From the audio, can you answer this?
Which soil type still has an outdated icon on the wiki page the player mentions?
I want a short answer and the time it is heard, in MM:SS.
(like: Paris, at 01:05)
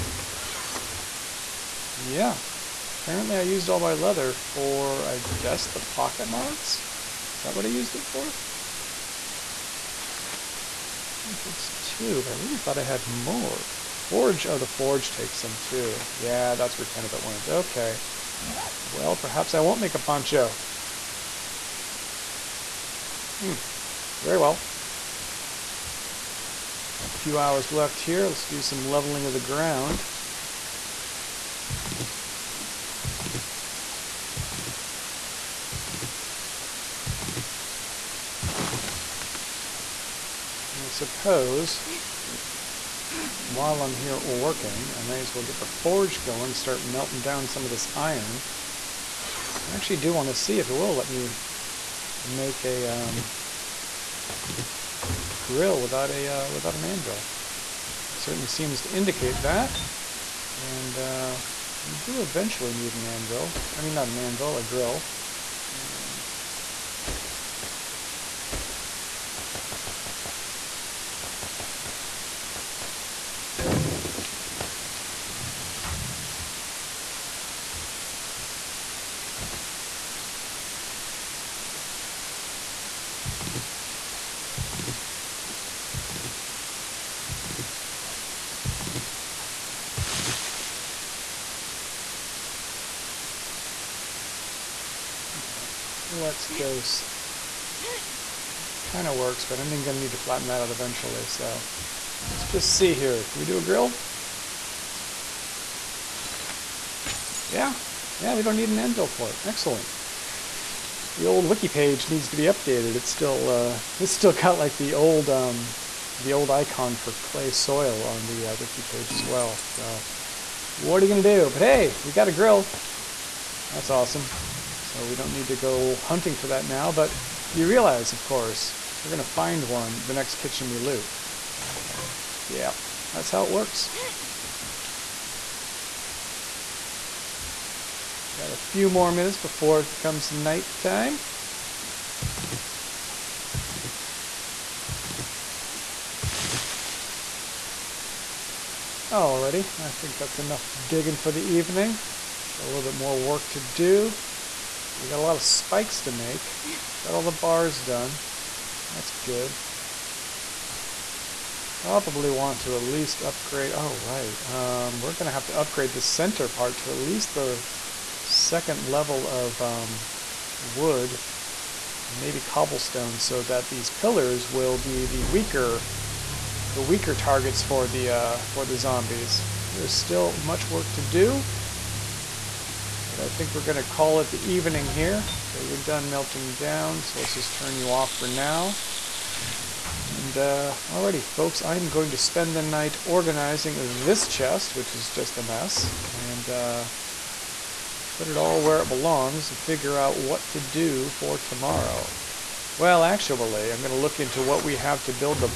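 Clay soil, at 01:57.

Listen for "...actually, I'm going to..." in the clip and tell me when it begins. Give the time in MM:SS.
03:23.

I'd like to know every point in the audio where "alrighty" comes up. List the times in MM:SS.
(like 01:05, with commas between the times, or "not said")
02:29, 03:10.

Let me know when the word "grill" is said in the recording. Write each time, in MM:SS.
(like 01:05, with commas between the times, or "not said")
00:55, 01:04, 01:43, 02:02.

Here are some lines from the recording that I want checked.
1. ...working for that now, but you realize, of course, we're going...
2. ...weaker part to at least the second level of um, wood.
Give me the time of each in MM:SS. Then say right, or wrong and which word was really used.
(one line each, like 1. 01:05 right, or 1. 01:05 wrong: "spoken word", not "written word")
1. 02:05 wrong: "hunting", not "working"
2. 02:46 wrong: "center", not "weaker".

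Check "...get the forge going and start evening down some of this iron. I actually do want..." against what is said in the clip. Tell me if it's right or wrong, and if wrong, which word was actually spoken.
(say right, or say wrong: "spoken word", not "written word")
wrong: "melting", not "evening".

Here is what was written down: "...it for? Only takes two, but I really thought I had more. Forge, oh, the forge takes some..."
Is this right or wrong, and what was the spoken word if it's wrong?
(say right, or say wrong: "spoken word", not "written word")
right.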